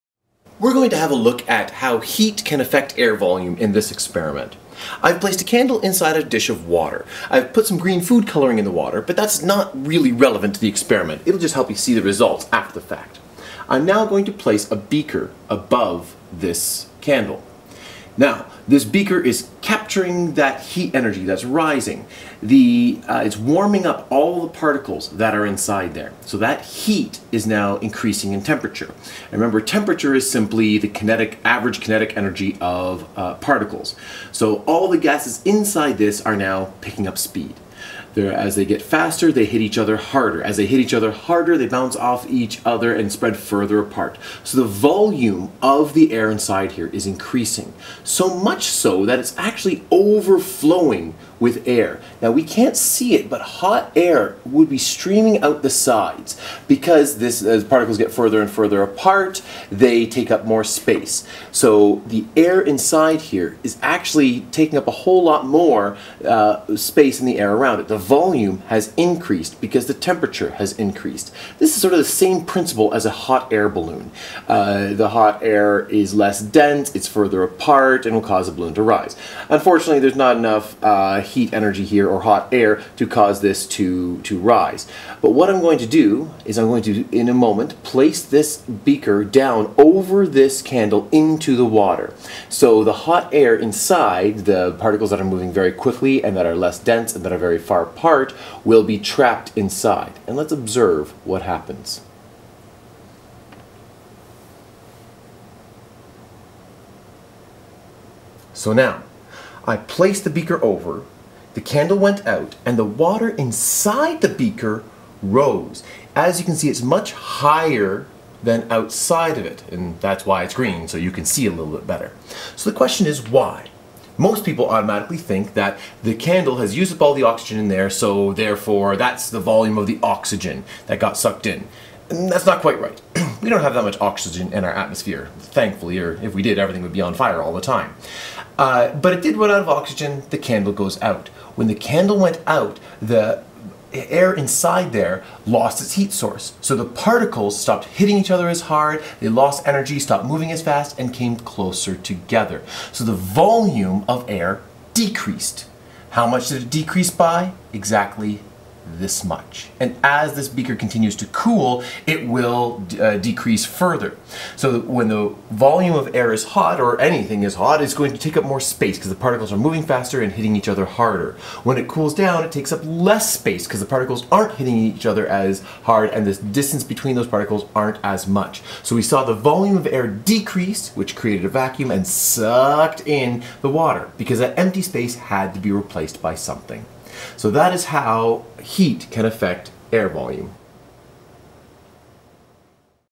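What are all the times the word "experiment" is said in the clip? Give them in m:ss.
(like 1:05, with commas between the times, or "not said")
0:03, 0:10.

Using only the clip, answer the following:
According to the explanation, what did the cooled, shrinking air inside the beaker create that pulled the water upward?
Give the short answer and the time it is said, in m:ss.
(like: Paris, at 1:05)
a vacuum, at 3:01.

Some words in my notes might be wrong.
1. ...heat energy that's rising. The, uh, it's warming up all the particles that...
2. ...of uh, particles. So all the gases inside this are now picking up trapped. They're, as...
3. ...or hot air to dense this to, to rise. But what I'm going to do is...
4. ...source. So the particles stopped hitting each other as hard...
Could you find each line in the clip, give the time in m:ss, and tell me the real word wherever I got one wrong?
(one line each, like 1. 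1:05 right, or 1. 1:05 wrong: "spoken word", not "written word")
1. 0:20 right
2. 0:32 wrong: "speed", not "trapped"
3. 1:22 wrong: "cause", not "dense"
4. 2:26 right.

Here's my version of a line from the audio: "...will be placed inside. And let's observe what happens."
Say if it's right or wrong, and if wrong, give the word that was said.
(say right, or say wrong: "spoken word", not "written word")
wrong: "trapped", not "placed".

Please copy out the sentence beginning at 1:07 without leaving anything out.
The volume has increased because the temperature has increased.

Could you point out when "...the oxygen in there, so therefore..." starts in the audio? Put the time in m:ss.
2:07.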